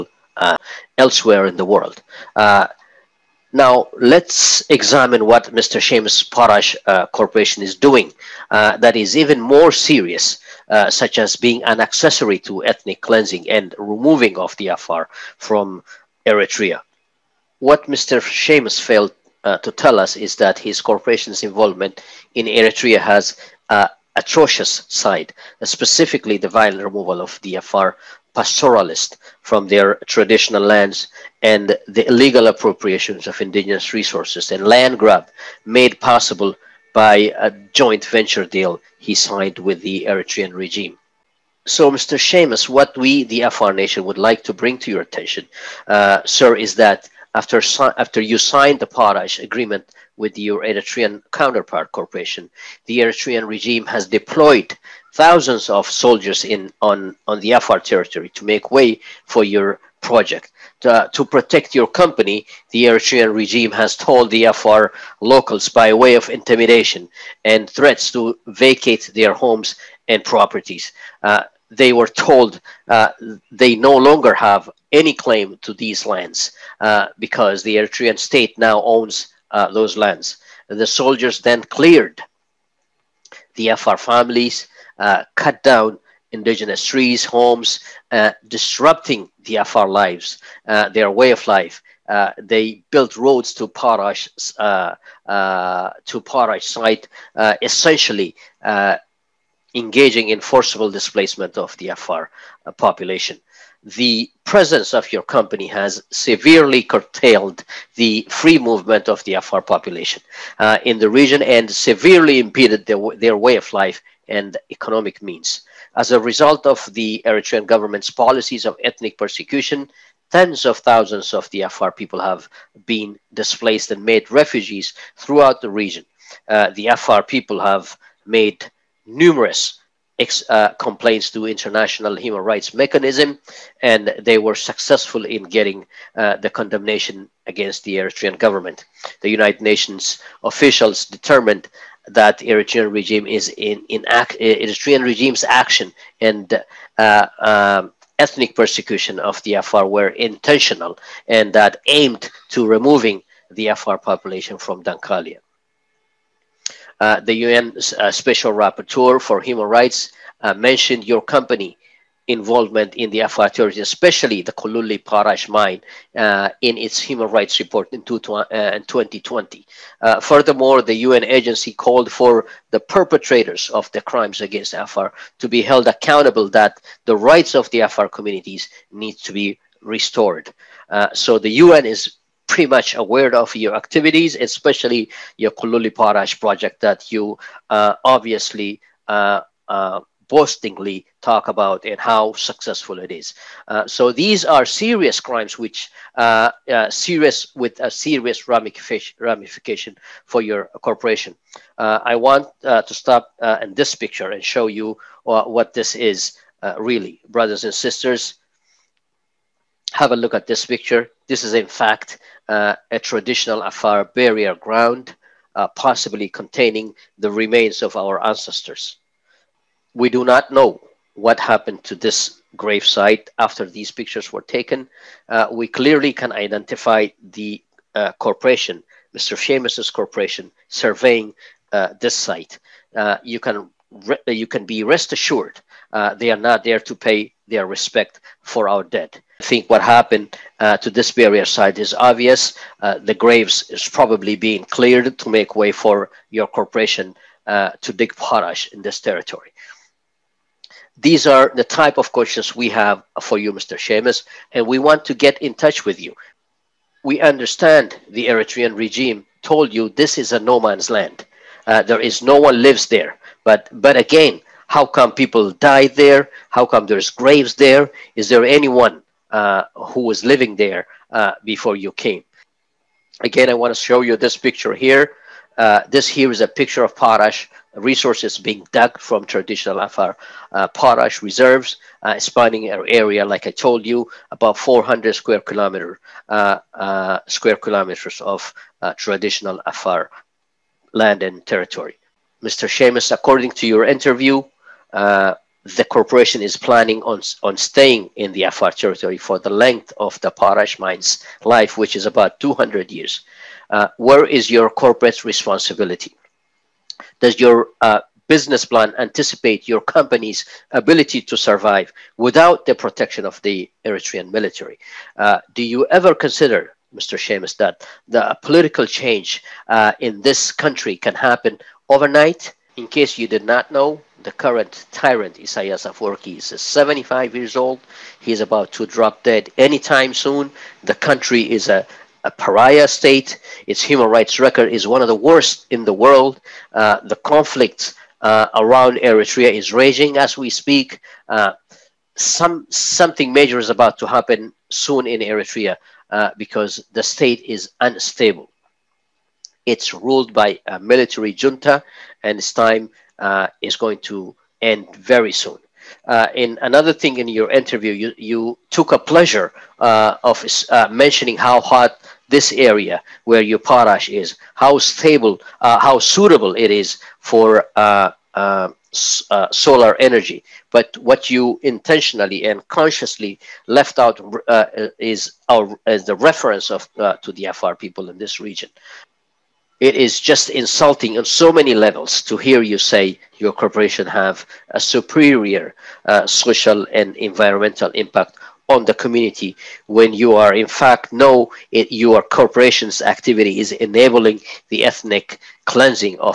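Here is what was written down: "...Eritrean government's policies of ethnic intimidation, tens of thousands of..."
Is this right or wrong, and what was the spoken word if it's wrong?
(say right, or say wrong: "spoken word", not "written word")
wrong: "persecution", not "intimidation".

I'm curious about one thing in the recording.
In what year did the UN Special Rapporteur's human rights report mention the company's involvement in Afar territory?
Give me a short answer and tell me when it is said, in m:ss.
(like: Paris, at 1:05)
2020, at 2:48.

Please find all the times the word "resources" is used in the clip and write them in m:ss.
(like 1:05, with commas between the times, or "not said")
0:33, 4:37.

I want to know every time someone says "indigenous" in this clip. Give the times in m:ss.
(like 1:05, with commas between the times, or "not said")
0:33, 1:26.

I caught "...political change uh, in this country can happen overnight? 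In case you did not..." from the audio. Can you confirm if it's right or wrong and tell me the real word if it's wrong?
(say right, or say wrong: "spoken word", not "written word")
right.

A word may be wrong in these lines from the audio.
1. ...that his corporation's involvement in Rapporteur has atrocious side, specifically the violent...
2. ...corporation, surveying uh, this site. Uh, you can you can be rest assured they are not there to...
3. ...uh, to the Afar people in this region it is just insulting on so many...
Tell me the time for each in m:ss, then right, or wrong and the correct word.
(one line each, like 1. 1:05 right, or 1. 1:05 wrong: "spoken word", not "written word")
1. 0:20 wrong: "Eritrea", not "Rapporteur"
2. 3:49 right
3. 6:16 right.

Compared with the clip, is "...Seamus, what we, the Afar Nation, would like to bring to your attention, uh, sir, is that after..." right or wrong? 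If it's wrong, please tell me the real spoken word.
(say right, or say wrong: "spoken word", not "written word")
right.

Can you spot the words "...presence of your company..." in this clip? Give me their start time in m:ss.
1:44.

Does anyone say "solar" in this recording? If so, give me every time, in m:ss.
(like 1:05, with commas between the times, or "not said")
6:08.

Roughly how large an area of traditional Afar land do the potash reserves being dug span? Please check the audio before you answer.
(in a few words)
400 square kilometers.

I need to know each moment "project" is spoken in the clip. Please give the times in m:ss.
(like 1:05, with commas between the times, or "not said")
1:00, 3:06.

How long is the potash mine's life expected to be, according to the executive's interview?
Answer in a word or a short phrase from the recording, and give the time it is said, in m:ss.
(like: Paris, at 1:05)
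200 years, at 5:02.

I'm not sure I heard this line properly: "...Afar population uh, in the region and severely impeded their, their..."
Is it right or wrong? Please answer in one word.
right.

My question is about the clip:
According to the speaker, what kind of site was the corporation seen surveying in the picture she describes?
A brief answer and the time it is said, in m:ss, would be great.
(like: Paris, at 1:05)
Burial ground, at 3:34.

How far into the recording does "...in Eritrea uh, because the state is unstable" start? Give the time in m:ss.
5:45.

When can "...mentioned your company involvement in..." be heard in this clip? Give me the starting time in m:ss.
2:40.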